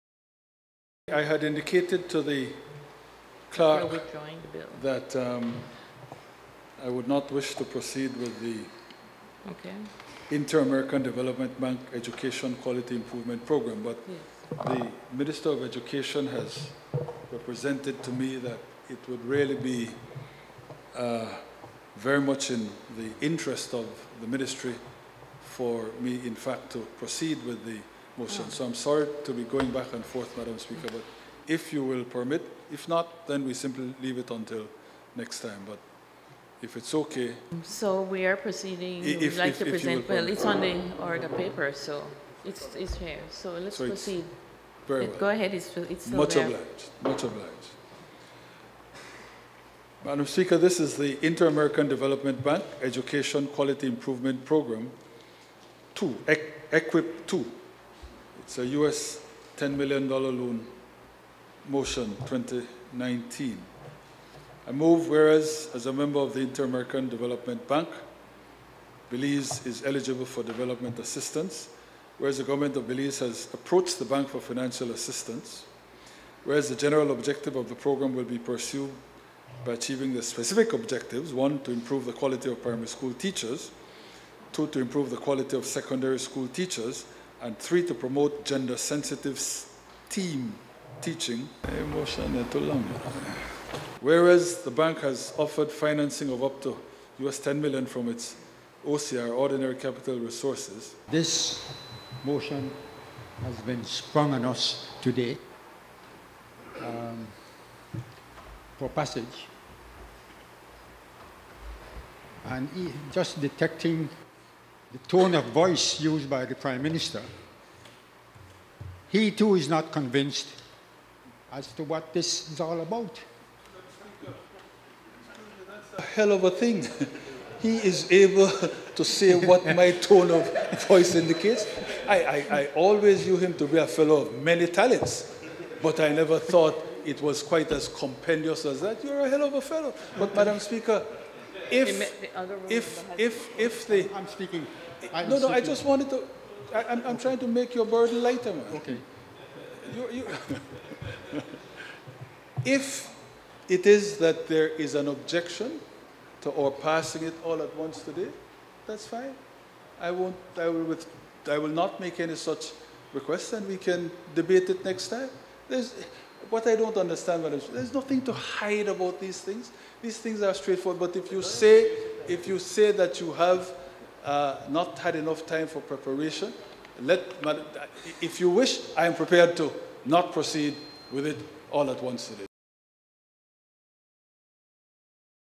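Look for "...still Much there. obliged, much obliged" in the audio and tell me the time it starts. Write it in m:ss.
0:46.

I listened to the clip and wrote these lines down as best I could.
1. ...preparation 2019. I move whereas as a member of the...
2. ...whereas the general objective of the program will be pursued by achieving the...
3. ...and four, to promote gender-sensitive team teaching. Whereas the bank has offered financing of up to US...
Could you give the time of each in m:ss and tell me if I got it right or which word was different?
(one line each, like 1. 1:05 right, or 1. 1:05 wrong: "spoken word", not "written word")
1. 1:01 wrong: "motion", not "preparation"
2. 1:16 right
3. 1:27 wrong: "three", not "four".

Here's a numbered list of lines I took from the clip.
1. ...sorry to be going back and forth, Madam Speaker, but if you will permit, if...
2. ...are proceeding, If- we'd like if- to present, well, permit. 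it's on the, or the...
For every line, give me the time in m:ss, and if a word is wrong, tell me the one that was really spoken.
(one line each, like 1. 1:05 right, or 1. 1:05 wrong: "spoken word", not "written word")
1. 0:28 right
2. 0:38 right.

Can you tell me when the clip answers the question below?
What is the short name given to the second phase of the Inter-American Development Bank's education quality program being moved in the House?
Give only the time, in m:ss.
0:56.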